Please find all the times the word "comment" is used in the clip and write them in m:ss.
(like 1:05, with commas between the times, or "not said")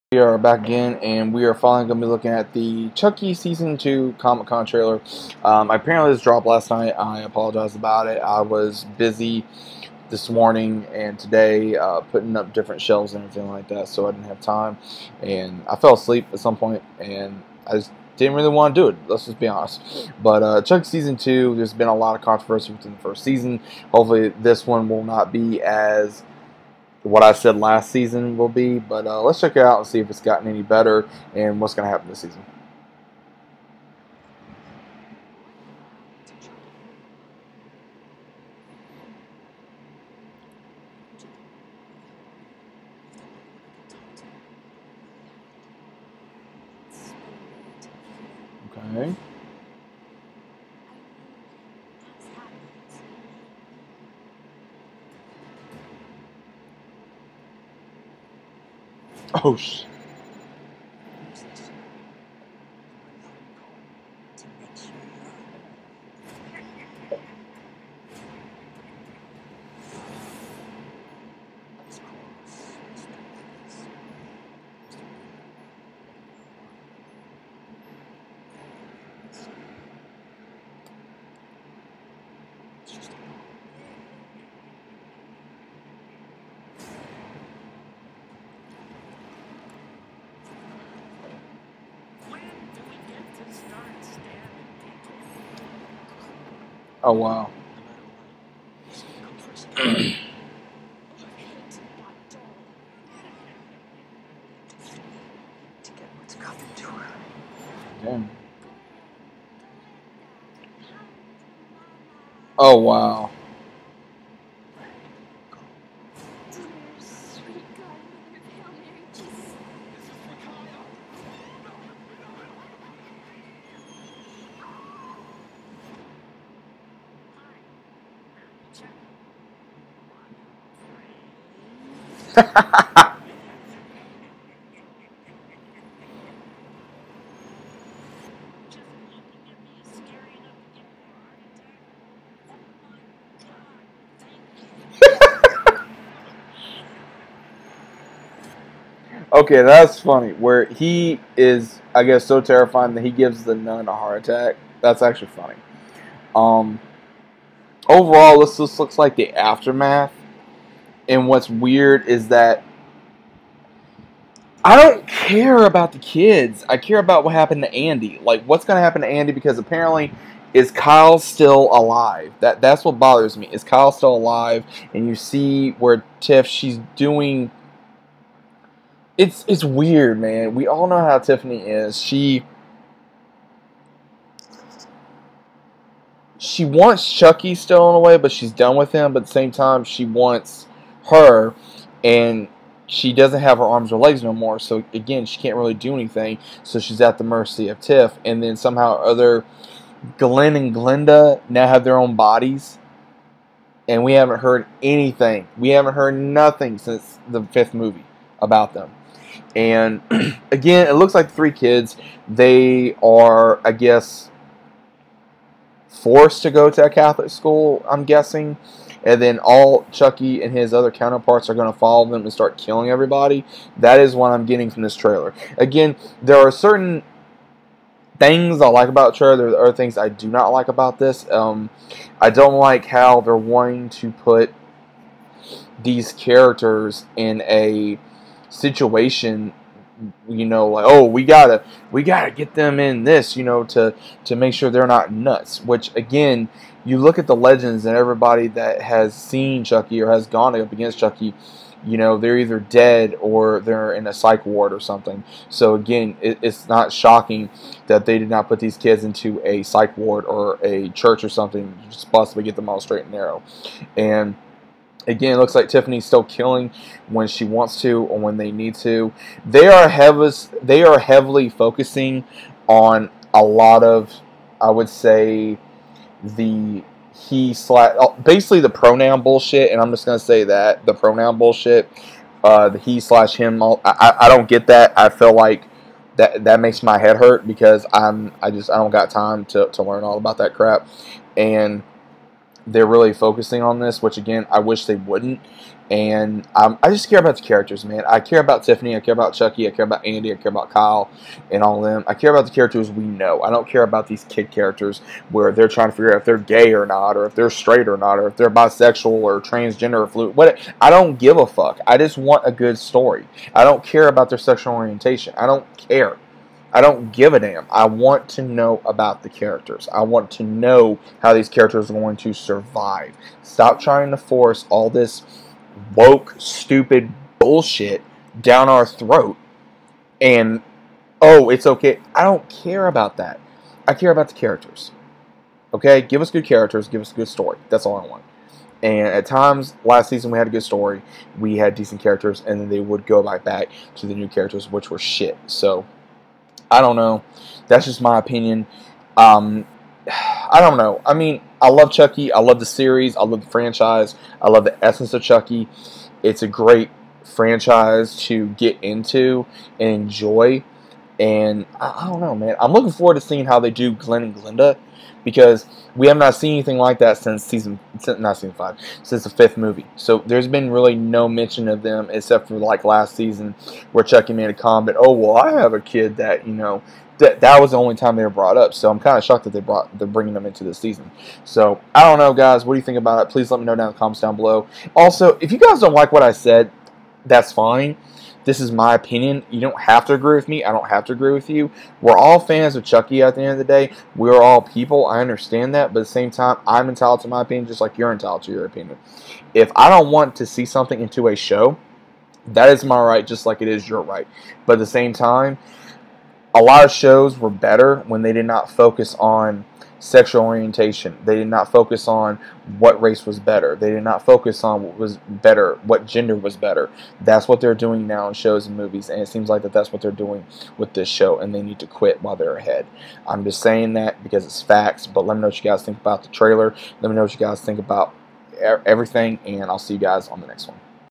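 6:14, 6:23.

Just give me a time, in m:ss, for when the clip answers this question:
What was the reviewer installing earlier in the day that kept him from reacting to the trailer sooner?
0:12.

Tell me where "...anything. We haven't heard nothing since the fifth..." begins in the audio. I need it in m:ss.
3:24.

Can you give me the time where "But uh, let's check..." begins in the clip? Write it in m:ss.
0:28.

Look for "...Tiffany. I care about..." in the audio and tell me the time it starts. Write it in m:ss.
4:58.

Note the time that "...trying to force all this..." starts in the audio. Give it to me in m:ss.
5:23.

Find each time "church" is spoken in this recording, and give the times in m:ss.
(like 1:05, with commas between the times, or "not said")
4:20.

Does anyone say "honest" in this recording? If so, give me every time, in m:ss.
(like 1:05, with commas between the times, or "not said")
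0:19.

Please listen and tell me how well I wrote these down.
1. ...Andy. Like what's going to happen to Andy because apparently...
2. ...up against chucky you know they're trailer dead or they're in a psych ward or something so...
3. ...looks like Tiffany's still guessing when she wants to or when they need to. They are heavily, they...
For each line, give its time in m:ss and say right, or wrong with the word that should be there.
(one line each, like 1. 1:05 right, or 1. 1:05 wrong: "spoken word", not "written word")
1. 2:47 right
2. 4:10 wrong: "either", not "trailer"
3. 4:25 wrong: "killing", not "guessing".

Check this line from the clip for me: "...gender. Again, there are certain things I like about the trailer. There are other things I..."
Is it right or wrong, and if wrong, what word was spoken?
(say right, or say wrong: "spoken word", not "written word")
wrong: "trailer", not "gender".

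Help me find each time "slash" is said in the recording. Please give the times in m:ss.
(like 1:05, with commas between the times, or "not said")
4:37, 4:42.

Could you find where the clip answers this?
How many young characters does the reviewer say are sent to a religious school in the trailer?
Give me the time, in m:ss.
3:31.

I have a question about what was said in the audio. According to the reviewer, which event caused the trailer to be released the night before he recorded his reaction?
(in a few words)
Comic Con.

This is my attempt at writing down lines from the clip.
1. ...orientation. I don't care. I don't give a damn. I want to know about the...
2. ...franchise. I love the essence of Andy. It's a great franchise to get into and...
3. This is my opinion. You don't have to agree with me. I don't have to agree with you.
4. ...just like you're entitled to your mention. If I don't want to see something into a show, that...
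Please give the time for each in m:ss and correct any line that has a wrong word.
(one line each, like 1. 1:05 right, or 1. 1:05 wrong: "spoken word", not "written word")
1. 5:14 right
2. 5:53 wrong: "Chucky", not "Andy"
3. 6:28 right
4. 6:37 wrong: "opinion", not "mention".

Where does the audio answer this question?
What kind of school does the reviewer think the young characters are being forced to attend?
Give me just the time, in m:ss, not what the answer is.
3:36.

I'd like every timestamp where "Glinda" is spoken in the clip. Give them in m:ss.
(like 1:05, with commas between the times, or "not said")
3:20, 6:04.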